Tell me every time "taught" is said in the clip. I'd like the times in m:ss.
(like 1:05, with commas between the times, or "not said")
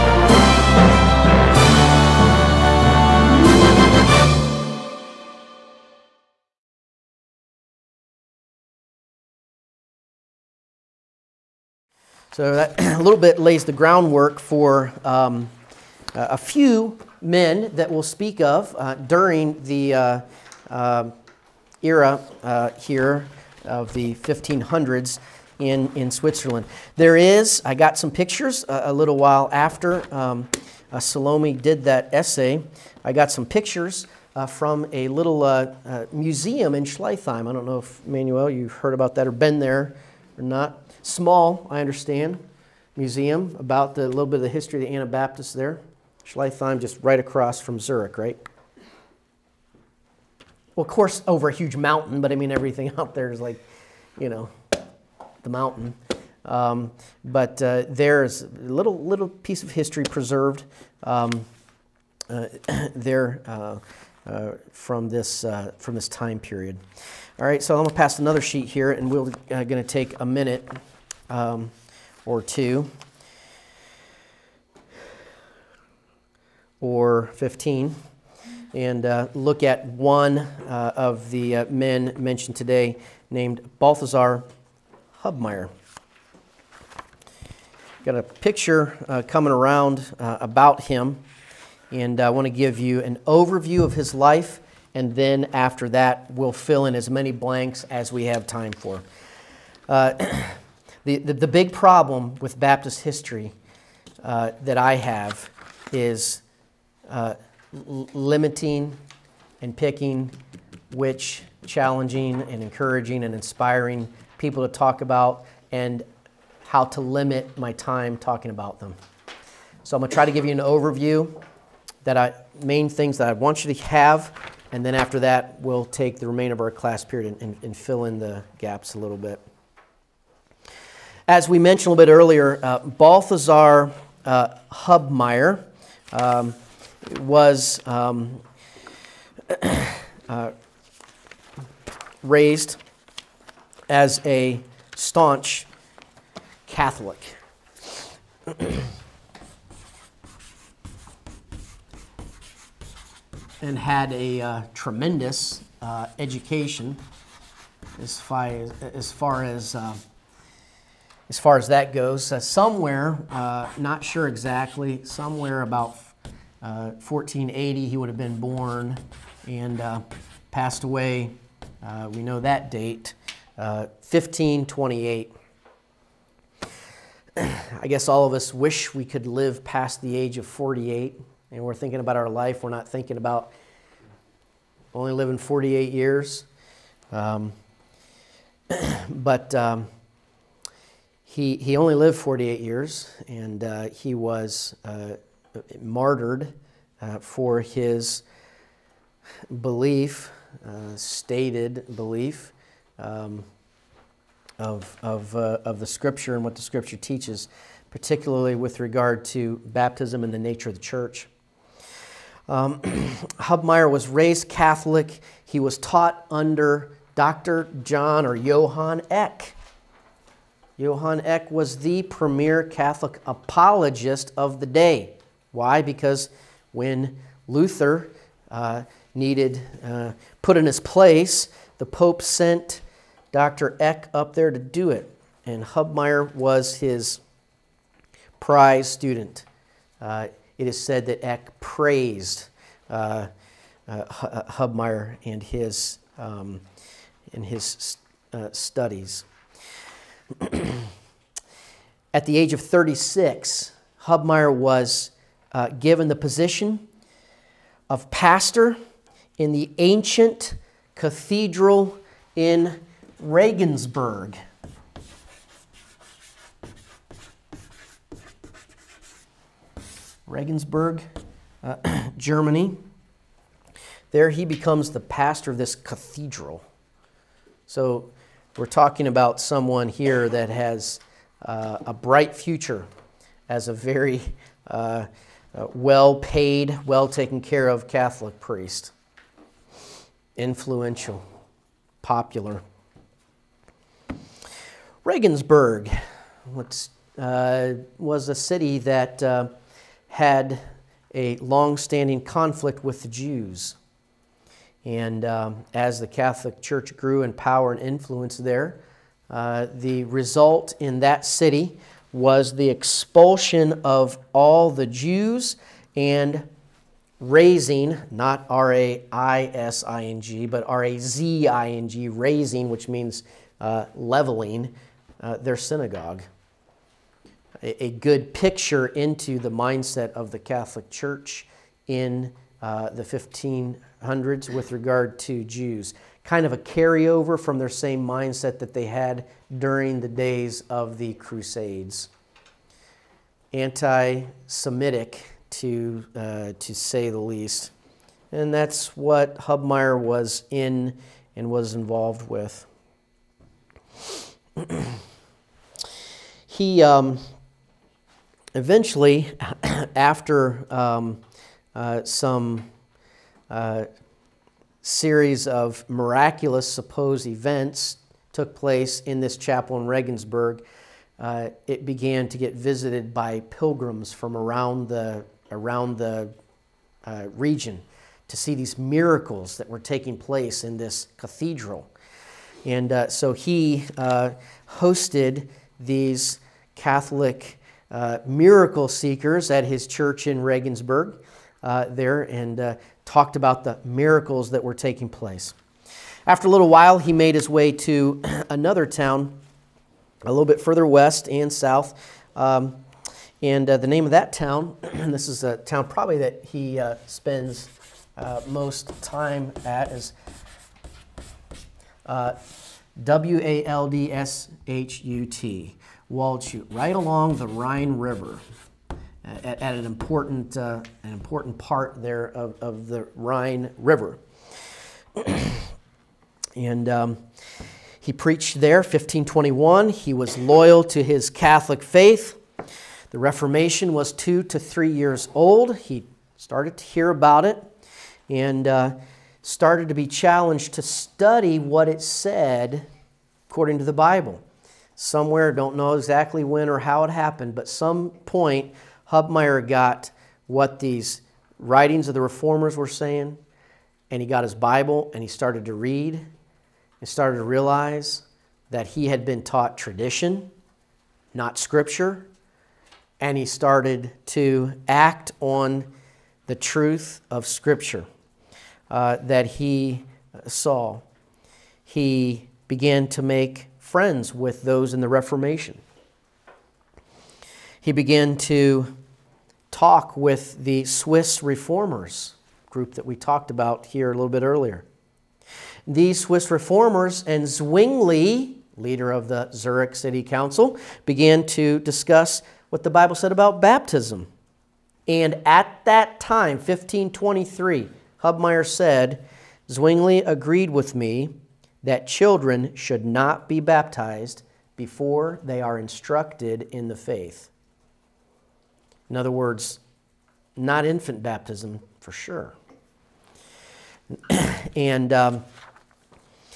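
3:35, 7:39.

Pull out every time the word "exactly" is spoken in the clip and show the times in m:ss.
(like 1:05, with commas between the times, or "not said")
2:44, 7:25.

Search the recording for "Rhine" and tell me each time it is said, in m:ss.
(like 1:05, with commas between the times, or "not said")
6:57, 7:03.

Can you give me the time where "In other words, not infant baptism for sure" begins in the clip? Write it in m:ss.
8:29.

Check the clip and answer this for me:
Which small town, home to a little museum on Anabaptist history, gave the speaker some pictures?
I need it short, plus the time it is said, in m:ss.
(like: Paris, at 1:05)
Schleitheim, at 0:36.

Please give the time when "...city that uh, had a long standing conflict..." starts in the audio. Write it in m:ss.
4:58.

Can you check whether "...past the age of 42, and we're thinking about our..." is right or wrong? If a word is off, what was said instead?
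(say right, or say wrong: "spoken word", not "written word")
wrong: "48", not "42".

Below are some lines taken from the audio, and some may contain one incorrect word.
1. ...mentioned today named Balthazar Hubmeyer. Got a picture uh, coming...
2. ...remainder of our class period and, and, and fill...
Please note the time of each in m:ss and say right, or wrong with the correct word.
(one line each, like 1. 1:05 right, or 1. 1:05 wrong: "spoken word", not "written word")
1. 1:22 right
2. 2:06 right.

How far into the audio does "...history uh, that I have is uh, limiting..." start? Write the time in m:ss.
1:43.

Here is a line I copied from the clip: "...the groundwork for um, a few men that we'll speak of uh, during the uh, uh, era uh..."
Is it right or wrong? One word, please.
right.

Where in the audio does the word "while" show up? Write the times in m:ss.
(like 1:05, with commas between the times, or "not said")
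0:29, 6:36.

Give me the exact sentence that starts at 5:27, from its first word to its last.
A, a good picture into the mindset of the Catholic Church in uh, the 1500s with regard to Jews.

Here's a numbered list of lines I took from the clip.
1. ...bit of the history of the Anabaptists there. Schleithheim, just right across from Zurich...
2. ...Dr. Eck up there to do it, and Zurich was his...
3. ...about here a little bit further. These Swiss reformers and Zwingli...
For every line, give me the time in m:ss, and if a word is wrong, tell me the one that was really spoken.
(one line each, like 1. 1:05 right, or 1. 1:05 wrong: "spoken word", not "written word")
1. 0:44 right
2. 3:53 wrong: "Hubmaier", not "Zurich"
3. 8:03 wrong: "earlier", not "further".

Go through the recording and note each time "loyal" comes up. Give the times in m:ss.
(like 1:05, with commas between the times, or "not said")
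7:10.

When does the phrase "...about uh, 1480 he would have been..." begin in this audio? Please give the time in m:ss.
2:45.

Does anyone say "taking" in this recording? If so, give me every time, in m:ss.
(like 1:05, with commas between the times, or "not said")
6:19, 6:34.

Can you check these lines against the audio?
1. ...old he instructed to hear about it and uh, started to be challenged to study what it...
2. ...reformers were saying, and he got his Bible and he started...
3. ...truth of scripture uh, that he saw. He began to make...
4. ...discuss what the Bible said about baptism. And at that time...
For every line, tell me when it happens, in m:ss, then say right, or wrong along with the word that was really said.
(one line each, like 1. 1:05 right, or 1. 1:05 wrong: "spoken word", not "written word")
1. 7:15 wrong: "started", not "instructed"
2. 7:32 right
3. 7:46 right
4. 8:11 right.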